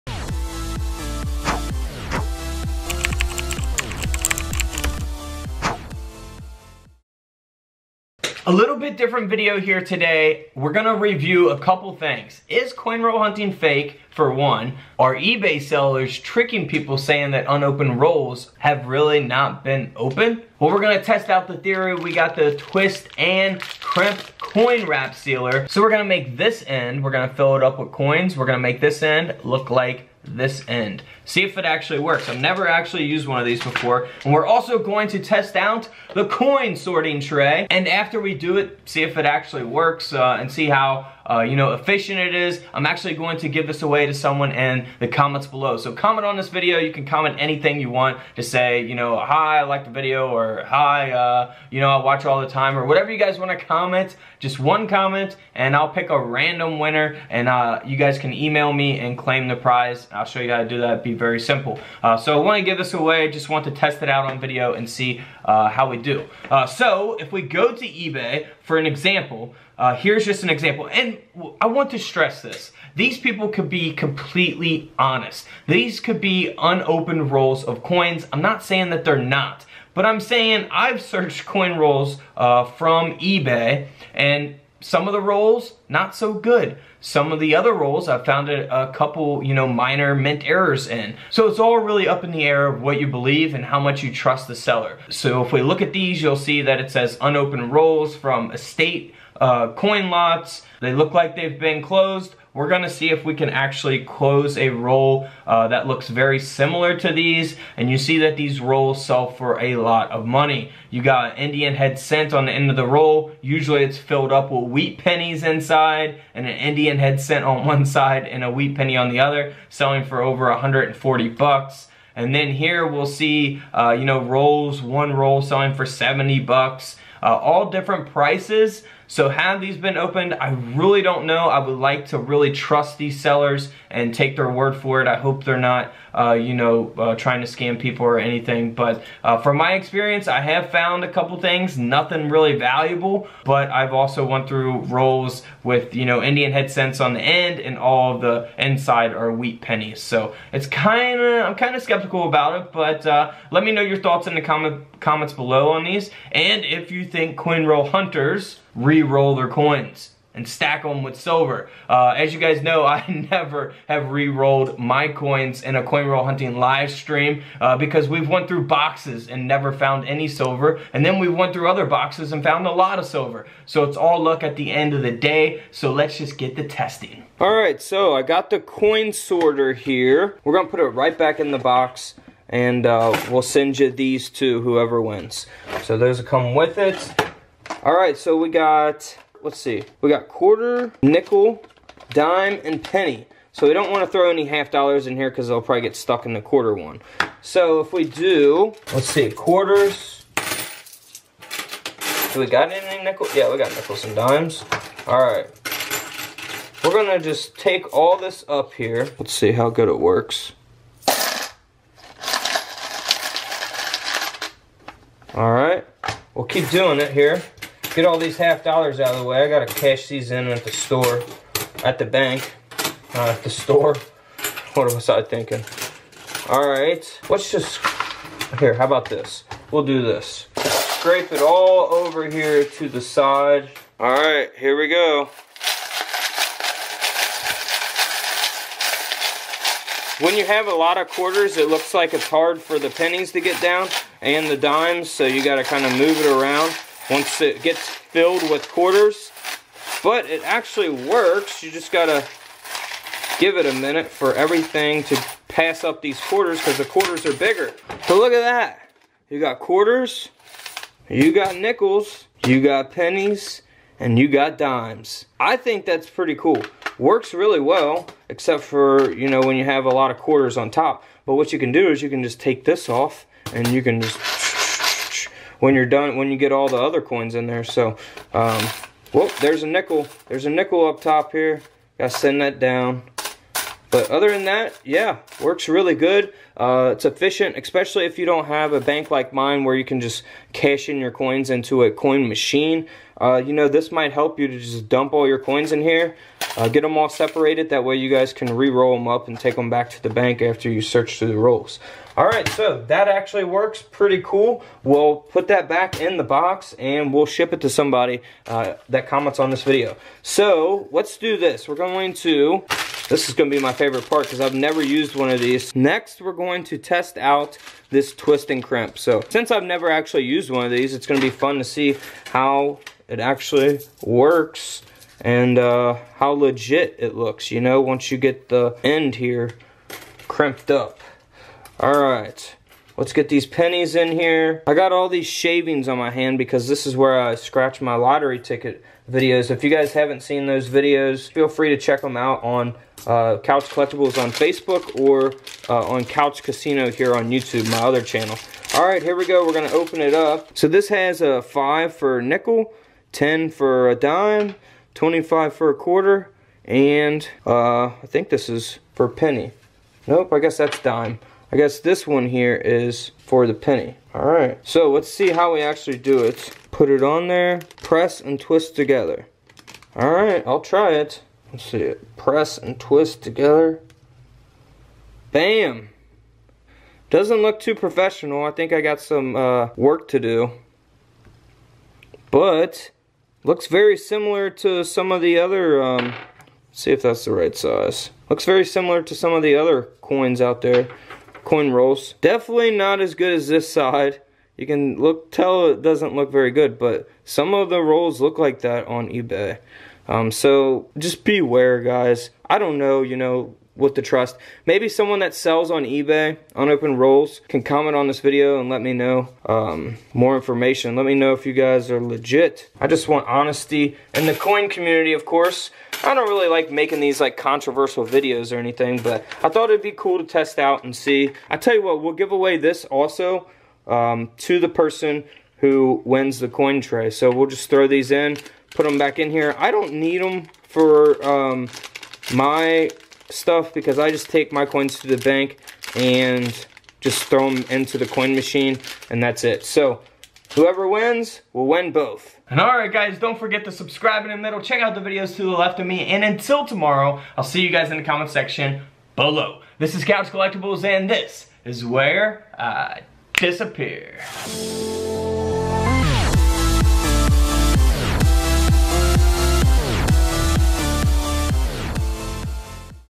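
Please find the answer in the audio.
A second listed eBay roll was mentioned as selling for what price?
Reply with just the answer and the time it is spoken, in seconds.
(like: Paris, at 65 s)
70 bucks, at 125 s.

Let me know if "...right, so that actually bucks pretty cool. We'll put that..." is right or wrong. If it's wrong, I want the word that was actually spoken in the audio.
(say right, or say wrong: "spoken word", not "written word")
wrong: "works", not "bucks".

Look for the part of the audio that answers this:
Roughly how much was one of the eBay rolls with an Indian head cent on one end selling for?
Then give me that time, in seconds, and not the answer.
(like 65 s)
120 s.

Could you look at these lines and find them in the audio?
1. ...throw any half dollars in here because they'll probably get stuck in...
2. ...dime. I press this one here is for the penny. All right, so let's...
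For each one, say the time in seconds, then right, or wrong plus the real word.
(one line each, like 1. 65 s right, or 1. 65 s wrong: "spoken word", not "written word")
1. 194 s right
2. 360 s wrong: "guess", not "press".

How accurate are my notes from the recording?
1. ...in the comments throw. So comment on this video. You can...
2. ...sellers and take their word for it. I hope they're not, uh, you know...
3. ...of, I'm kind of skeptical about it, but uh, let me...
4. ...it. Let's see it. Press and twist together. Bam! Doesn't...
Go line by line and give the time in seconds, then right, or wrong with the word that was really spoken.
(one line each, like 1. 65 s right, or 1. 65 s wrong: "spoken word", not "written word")
1. 44 s wrong: "below", not "throw"
2. 133 s right
3. 151 s right
4. 370 s right.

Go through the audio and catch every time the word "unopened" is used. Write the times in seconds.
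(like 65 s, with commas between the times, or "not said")
17 s, 76 s, 97 s, 406 s.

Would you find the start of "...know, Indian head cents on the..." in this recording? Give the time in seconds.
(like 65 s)
146 s.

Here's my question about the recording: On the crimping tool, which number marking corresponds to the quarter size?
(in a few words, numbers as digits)
25.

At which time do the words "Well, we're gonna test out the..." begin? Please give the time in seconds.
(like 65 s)
20 s.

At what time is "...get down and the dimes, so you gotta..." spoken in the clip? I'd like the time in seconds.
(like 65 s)
243 s.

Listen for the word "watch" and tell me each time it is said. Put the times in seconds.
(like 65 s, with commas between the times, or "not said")
52 s.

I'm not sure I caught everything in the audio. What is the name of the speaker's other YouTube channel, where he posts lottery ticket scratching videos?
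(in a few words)
Couch Casino.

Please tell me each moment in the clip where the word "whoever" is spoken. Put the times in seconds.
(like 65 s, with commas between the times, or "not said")
184 s, 440 s.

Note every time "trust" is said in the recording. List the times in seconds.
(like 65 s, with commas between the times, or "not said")
94 s, 132 s, 404 s.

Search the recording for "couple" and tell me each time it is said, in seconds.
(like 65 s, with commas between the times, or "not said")
11 s, 88 s, 141 s.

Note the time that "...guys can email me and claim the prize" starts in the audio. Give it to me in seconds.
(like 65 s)
57 s.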